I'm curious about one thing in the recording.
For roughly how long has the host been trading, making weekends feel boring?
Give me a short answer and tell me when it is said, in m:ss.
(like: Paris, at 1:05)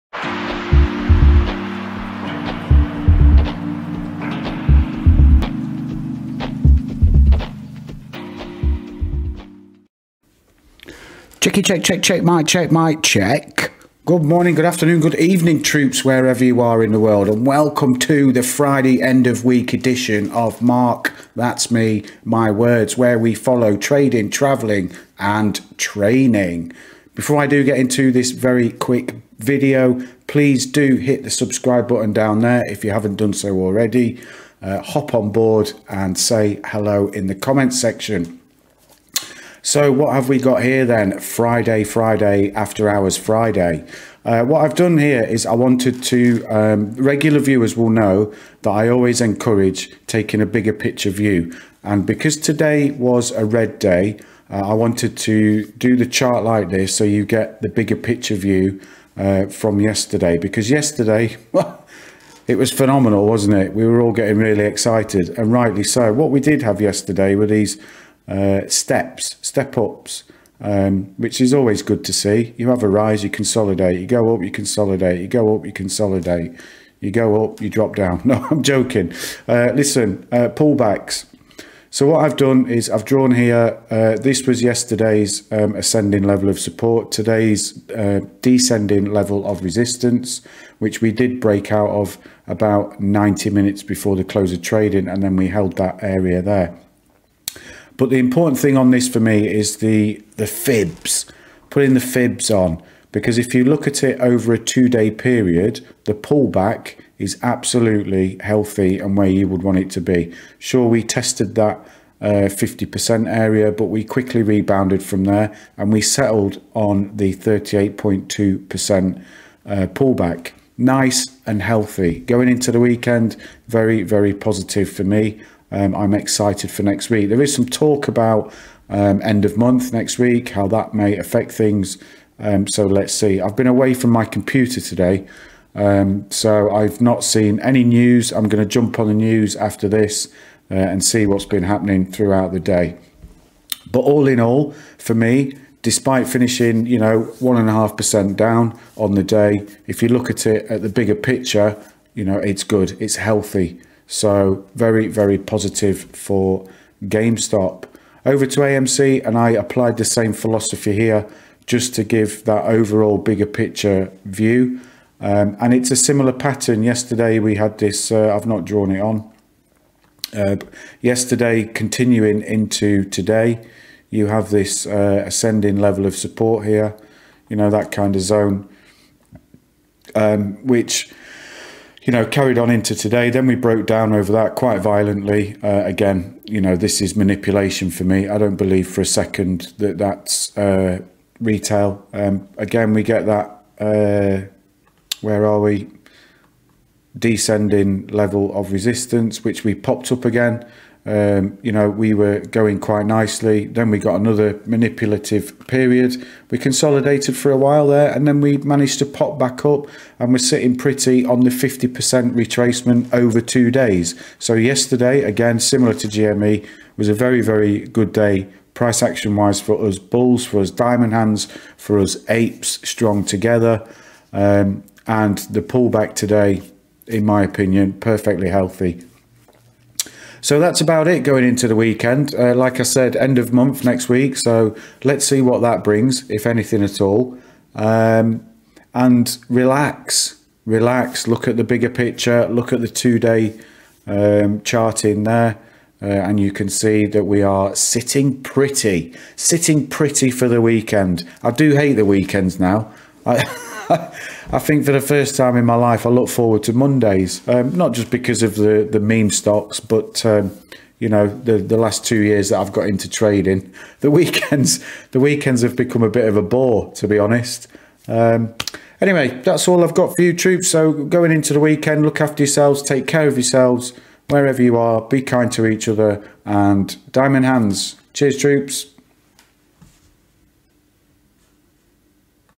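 2 years, at 4:22.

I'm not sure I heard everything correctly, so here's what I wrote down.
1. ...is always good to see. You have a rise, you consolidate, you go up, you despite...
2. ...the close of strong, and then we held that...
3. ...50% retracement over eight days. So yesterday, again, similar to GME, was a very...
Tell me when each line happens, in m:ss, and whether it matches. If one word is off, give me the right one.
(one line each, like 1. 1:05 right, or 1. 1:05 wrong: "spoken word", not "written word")
1. 1:11 wrong: "consolidate", not "despite"
2. 1:34 wrong: "trading", not "strong"
3. 3:31 wrong: "two", not "eight".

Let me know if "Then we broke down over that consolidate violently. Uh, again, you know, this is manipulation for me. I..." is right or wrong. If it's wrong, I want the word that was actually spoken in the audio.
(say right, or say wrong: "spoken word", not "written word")
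wrong: "quite", not "consolidate".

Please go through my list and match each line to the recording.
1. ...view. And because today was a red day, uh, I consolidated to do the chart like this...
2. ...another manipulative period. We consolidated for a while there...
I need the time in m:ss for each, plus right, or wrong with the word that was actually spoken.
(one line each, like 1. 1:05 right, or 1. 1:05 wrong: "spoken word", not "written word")
1. 0:51 wrong: "wanted", not "consolidated"
2. 3:24 right.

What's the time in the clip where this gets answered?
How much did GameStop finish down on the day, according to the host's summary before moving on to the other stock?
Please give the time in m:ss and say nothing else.
2:27.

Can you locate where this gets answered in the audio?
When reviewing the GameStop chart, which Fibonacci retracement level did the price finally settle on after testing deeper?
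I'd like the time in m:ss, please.
1:57.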